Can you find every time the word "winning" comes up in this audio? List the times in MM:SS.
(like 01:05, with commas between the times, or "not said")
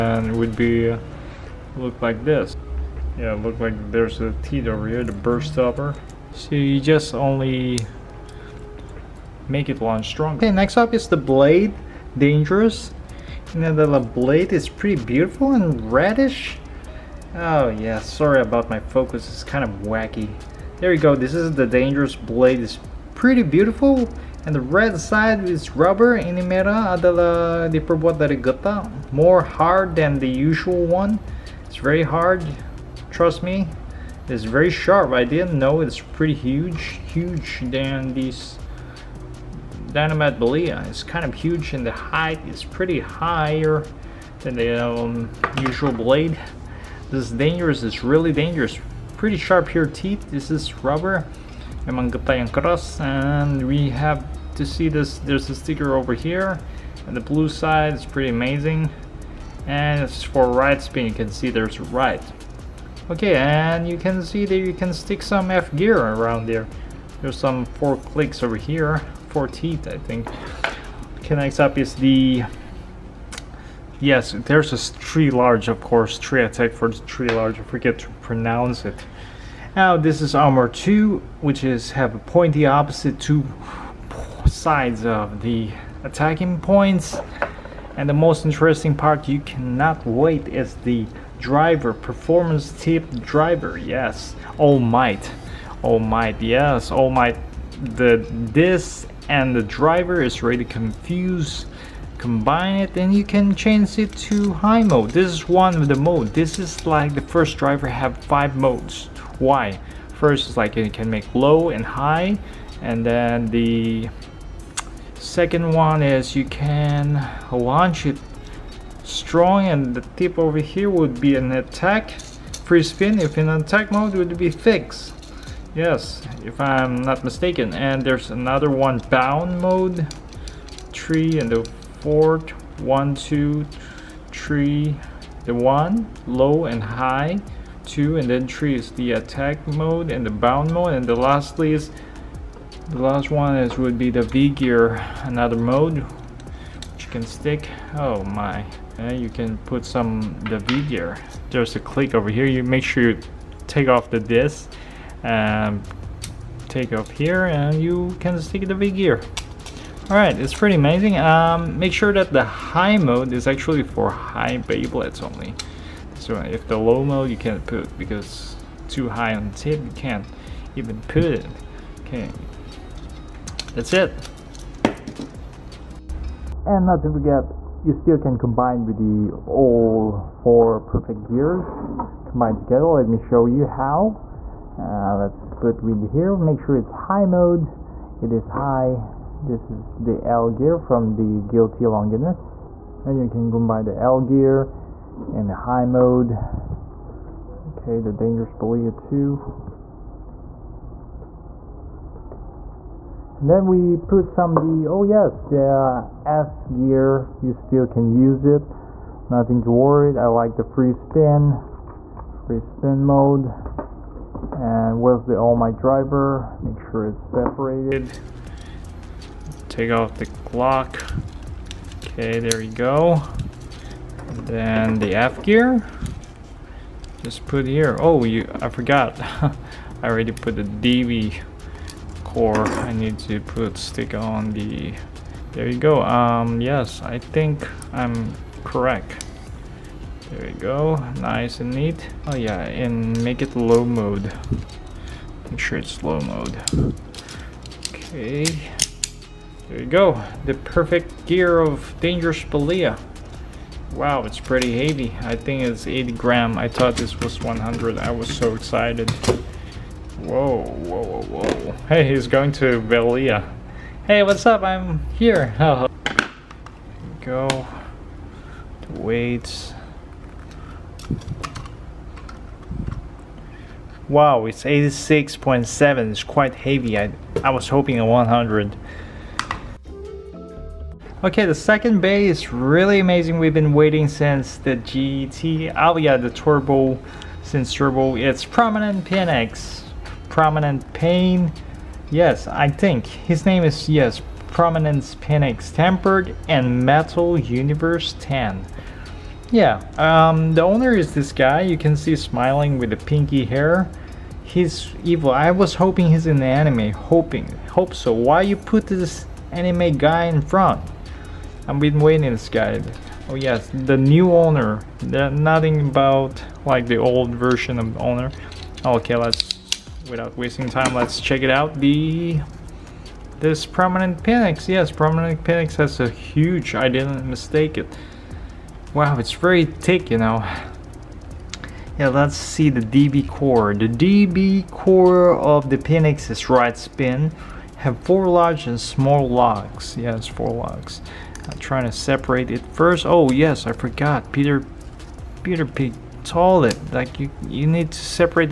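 not said.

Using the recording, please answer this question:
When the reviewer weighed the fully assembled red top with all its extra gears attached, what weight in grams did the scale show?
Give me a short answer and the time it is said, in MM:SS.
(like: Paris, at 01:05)
86.7, at 04:34.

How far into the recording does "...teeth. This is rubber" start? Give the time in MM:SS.
00:49.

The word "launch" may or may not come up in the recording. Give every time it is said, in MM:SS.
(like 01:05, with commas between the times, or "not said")
00:09, 01:57.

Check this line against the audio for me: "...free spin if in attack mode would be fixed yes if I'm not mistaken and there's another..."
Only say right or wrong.
right.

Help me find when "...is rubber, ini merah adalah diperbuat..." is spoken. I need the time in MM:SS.
00:25.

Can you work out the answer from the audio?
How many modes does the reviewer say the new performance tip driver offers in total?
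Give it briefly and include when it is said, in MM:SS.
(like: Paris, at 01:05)
5, at 01:48.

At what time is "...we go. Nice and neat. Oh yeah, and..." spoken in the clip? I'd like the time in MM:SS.
04:00.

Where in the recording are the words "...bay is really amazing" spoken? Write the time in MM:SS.
04:42.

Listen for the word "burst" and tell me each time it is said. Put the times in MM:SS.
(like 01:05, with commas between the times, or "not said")
00:05.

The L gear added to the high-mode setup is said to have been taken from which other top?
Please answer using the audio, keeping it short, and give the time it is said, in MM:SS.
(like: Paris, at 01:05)
Guilty Longinus, at 03:11.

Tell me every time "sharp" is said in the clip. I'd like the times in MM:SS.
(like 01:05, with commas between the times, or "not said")
00:34, 00:49.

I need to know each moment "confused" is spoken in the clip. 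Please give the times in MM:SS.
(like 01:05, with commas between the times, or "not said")
01:40.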